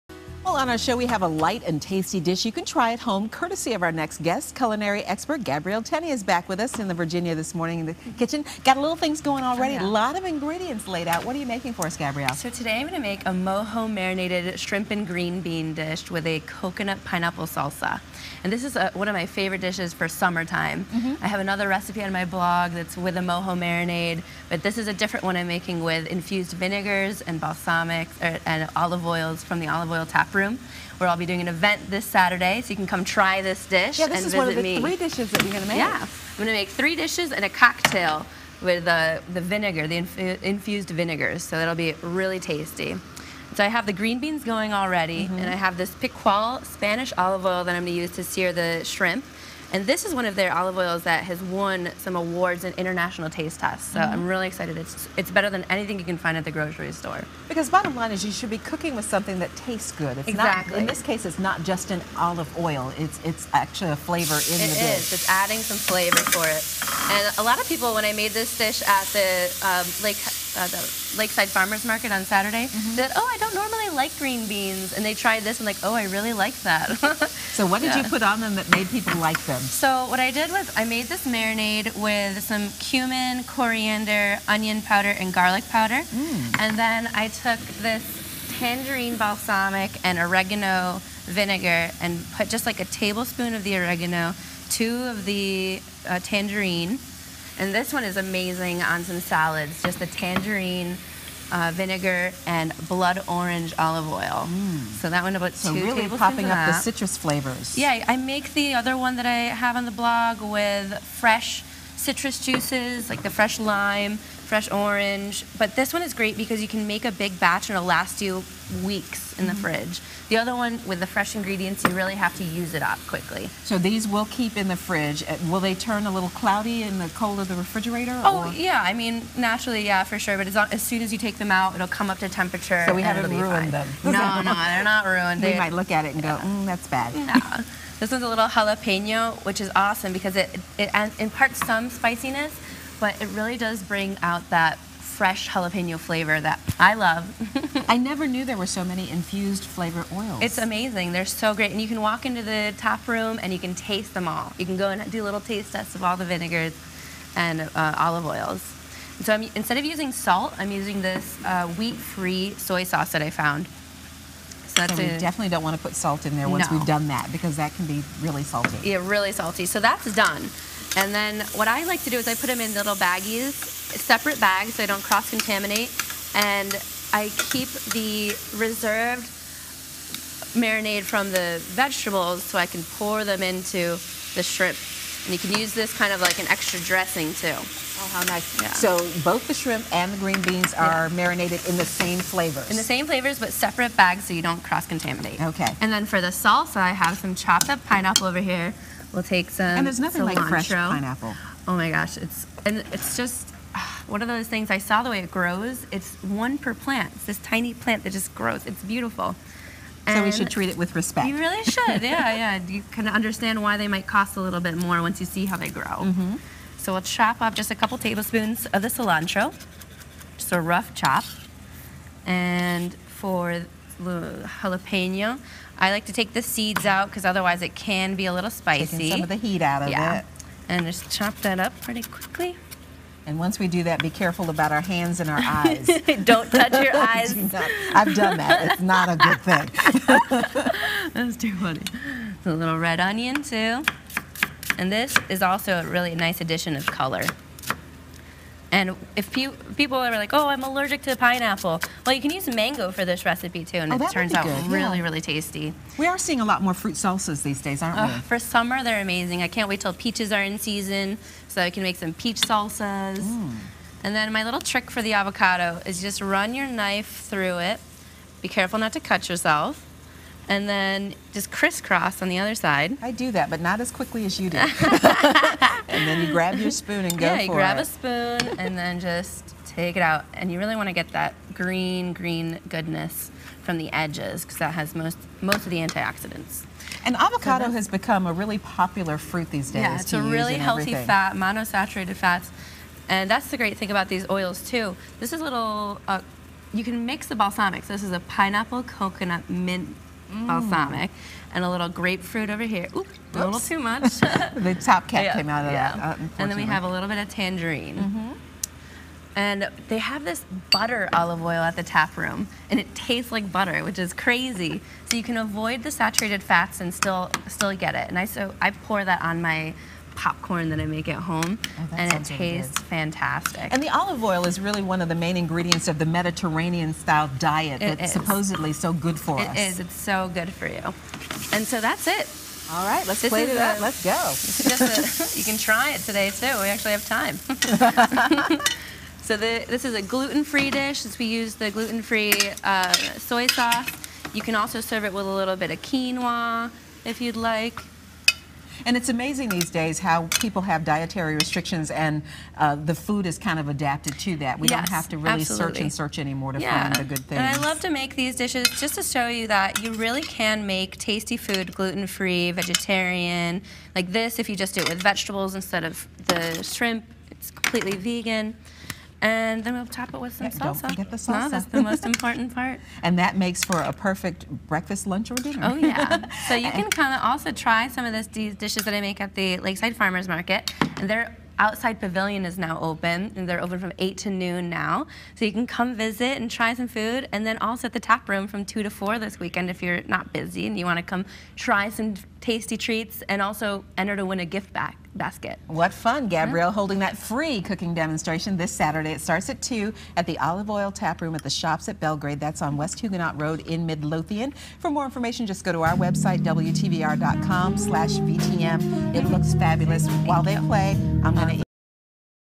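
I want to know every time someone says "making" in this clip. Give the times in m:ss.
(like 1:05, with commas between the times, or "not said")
0:11, 0:25.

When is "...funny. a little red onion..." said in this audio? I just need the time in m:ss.
4:01.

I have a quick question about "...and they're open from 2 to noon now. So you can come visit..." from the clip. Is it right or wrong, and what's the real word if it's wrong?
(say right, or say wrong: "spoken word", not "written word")
wrong: "8", not "2".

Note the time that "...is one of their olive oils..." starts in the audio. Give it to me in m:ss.
0:50.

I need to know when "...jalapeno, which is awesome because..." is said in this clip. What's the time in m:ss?
2:18.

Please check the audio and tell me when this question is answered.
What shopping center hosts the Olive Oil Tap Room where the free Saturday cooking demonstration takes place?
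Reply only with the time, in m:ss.
6:41.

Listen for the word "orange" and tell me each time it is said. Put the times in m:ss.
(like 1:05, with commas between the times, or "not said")
1:43, 1:54.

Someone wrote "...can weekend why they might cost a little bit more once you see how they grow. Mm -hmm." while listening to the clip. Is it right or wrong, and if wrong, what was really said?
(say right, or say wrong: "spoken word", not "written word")
wrong: "understand", not "weekend".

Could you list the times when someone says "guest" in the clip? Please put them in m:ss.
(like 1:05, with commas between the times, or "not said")
0:04.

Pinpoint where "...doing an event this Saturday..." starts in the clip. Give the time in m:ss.
0:31.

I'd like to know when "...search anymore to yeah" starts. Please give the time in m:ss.
5:55.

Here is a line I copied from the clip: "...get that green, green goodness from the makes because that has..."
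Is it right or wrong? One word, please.
wrong.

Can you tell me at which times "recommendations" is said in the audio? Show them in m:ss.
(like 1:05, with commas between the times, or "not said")
not said.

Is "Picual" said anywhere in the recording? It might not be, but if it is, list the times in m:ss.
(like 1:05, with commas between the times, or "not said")
0:45.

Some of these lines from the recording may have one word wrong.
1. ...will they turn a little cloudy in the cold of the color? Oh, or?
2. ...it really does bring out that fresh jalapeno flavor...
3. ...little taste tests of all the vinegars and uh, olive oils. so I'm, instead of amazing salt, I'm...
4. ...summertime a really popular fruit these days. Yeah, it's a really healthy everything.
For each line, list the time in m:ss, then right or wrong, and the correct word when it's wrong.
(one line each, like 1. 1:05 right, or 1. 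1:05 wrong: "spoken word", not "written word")
1. 2:05 wrong: "refrigerator", not "color"
2. 2:23 right
3. 2:35 wrong: "using", not "amazing"
4. 4:47 wrong: "become", not "summertime".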